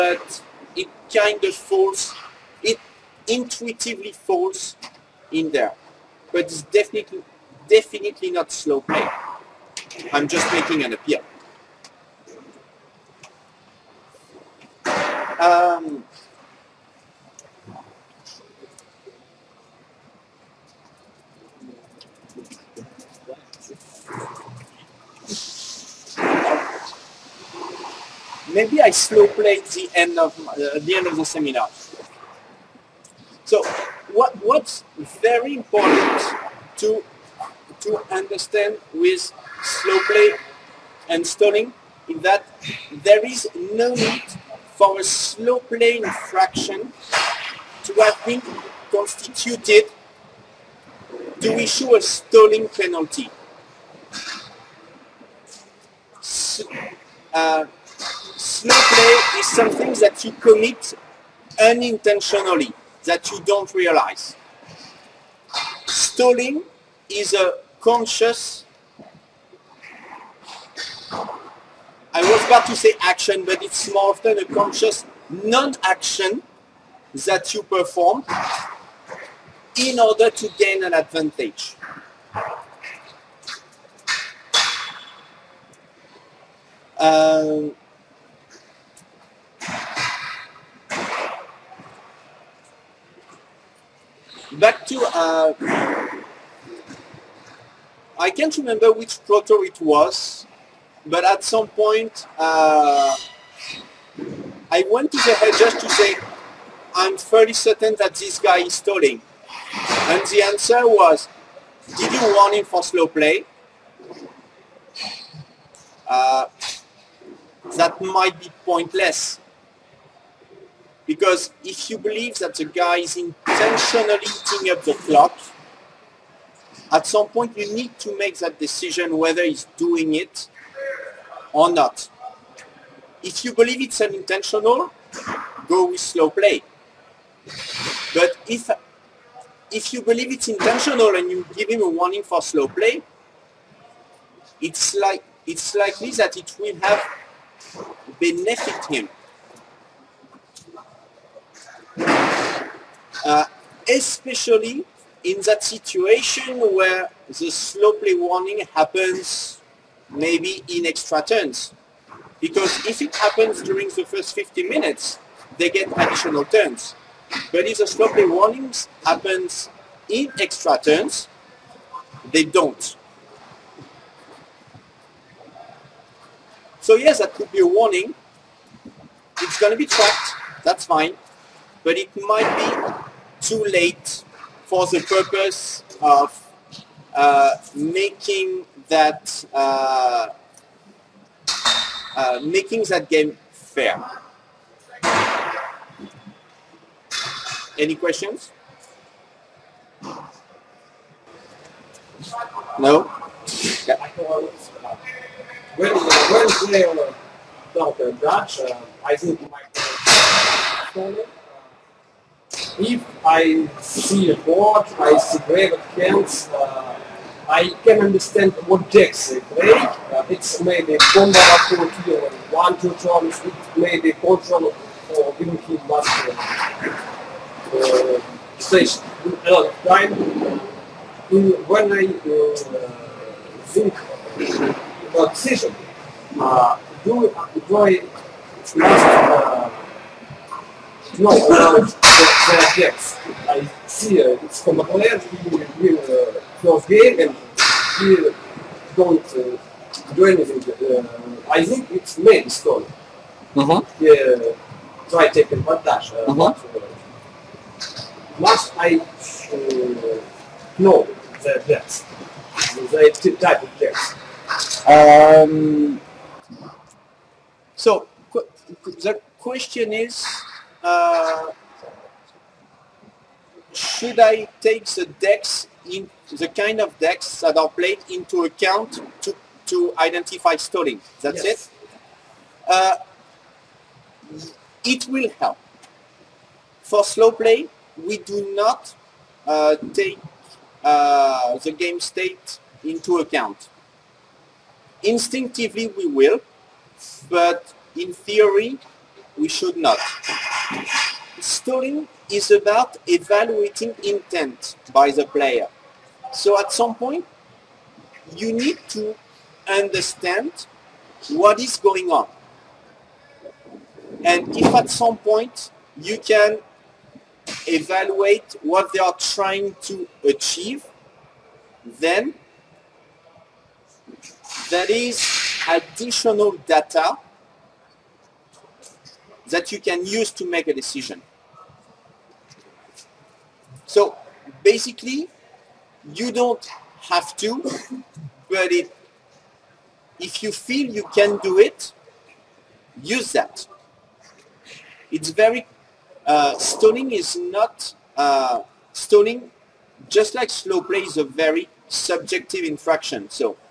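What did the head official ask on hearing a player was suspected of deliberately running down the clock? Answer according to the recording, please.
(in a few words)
Did you warn him for slow play?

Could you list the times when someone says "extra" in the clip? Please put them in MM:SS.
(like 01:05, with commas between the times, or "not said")
02:40, 02:50.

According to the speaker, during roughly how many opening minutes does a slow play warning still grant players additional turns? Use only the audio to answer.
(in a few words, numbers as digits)
50 minutes.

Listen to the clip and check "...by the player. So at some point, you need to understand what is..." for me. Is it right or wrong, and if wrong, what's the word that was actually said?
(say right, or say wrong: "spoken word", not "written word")
right.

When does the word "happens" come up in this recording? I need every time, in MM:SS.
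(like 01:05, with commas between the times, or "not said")
02:38, 02:43, 02:49.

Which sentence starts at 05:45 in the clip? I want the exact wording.
It's very, uh, stalling is not, uh, stalling, just like slow play is a very subjective infraction.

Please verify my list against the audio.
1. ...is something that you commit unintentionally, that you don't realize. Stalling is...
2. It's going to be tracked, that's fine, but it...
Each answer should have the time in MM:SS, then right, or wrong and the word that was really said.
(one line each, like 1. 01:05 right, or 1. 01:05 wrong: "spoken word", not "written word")
1. 00:59 right
2. 02:59 right.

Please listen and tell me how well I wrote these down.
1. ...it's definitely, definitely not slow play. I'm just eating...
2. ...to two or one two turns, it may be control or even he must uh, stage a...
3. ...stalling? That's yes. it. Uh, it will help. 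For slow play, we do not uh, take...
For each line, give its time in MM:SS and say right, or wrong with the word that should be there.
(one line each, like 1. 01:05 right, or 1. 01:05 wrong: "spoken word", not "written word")
1. 00:06 wrong: "making", not "eating"
2. 03:41 right
3. 04:40 right.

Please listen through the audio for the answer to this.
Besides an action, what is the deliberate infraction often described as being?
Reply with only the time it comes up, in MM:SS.
01:15.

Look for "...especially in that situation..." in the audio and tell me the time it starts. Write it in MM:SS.
02:33.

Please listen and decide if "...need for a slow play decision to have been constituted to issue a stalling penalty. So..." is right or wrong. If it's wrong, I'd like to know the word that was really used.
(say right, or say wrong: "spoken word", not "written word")
wrong: "infraction", not "decision".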